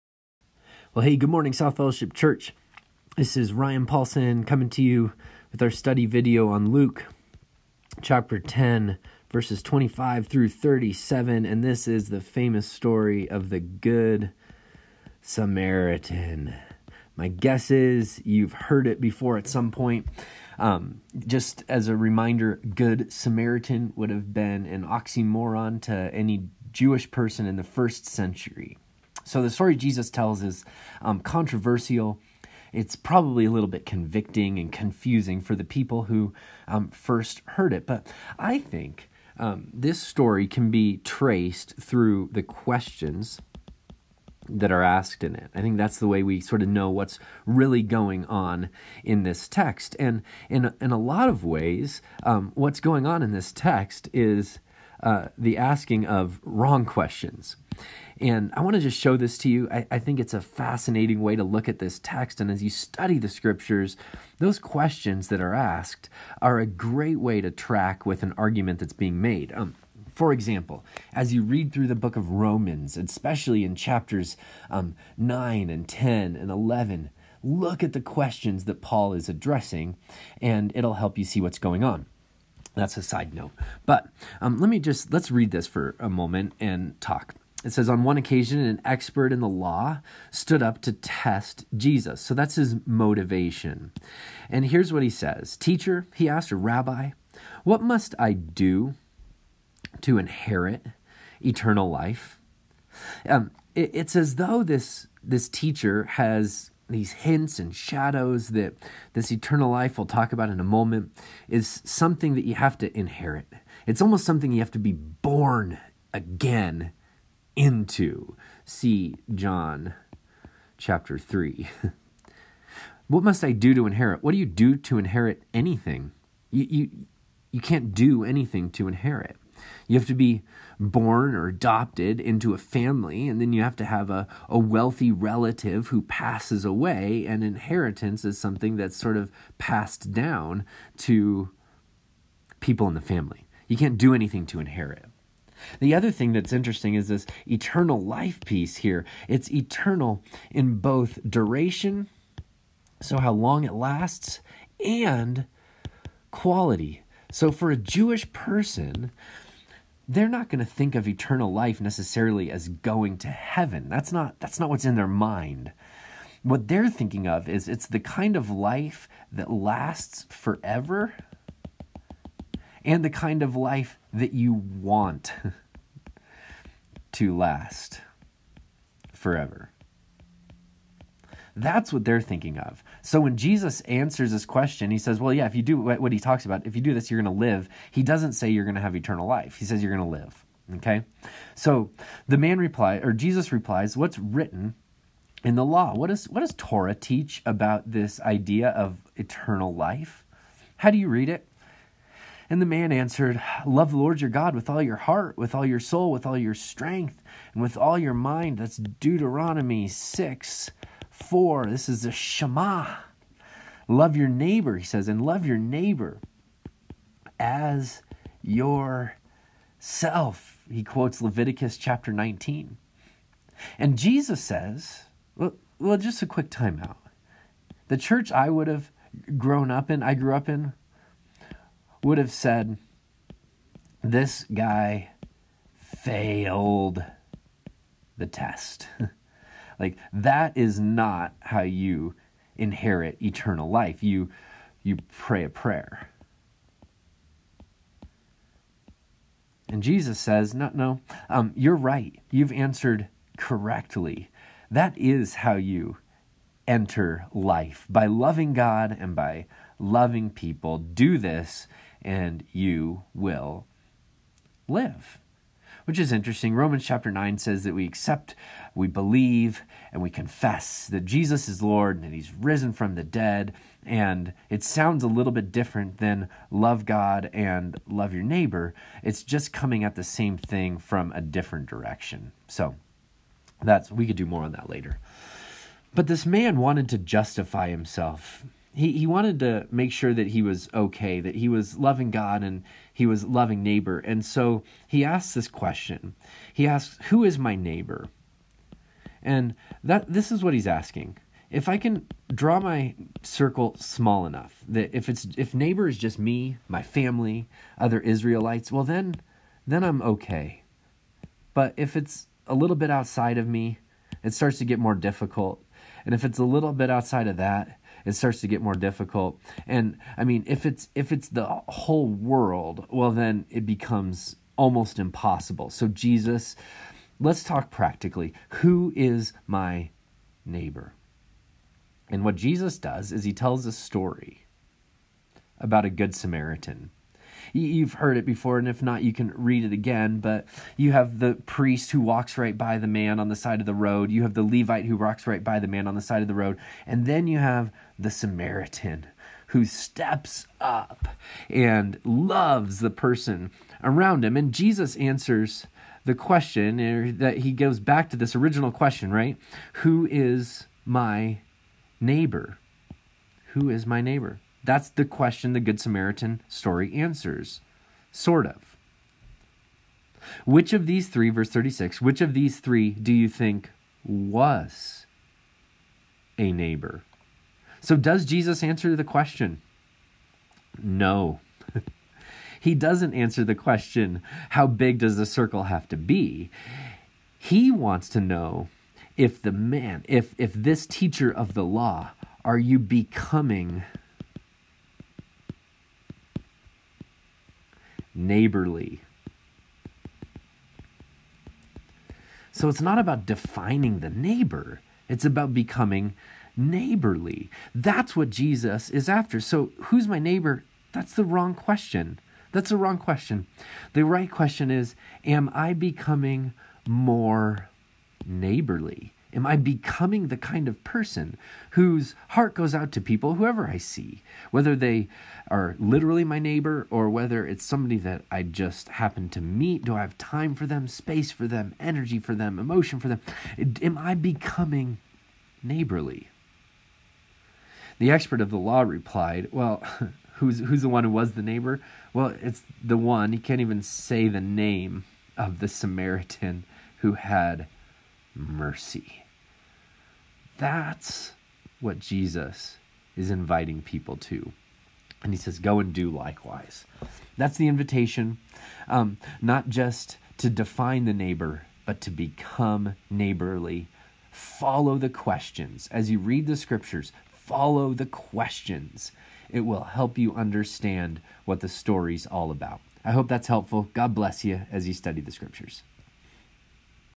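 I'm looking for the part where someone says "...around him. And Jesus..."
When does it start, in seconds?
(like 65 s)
353 s.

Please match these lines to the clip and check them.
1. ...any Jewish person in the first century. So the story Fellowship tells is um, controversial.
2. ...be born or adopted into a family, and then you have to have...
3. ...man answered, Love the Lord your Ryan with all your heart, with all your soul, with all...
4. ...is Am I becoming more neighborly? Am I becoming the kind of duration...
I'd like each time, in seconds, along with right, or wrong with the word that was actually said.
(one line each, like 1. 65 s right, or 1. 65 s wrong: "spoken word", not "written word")
1. 26 s wrong: "Jesus", not "Fellowship"
2. 130 s right
3. 202 s wrong: "God", not "Ryan"
4. 414 s wrong: "person", not "duration".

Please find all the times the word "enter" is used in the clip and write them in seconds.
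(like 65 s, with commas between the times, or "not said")
256 s.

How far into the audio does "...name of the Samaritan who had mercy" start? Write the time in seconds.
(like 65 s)
444 s.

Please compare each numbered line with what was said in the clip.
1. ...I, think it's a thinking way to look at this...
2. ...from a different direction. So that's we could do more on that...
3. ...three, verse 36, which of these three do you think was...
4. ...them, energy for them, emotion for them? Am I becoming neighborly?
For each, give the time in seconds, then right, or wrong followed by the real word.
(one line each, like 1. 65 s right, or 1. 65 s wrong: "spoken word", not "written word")
1. 59 s wrong: "fascinating", not "thinking"
2. 280 s right
3. 371 s right
4. 431 s right.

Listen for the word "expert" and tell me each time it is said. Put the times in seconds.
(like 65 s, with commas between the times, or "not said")
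88 s, 438 s.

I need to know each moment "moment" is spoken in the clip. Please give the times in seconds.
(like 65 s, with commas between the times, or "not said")
86 s, 110 s.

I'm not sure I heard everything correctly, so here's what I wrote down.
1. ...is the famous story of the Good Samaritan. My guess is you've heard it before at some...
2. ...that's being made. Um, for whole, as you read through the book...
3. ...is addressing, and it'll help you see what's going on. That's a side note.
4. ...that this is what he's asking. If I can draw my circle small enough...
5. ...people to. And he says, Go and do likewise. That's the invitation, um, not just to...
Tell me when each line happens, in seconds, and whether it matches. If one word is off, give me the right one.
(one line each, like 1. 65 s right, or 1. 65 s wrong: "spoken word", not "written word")
1. 11 s right
2. 68 s wrong: "example", not "whole"
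3. 79 s right
4. 299 s right
5. 453 s right.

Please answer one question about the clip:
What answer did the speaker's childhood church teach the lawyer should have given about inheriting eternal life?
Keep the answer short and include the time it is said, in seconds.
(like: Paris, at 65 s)
Pray a prayer, at 245 s.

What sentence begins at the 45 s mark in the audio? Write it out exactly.
I think that's the way we sort of know what's really going on in this text.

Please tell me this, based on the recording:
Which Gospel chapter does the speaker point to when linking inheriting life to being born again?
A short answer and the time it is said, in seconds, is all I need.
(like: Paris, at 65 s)
John chapter 3, at 119 s.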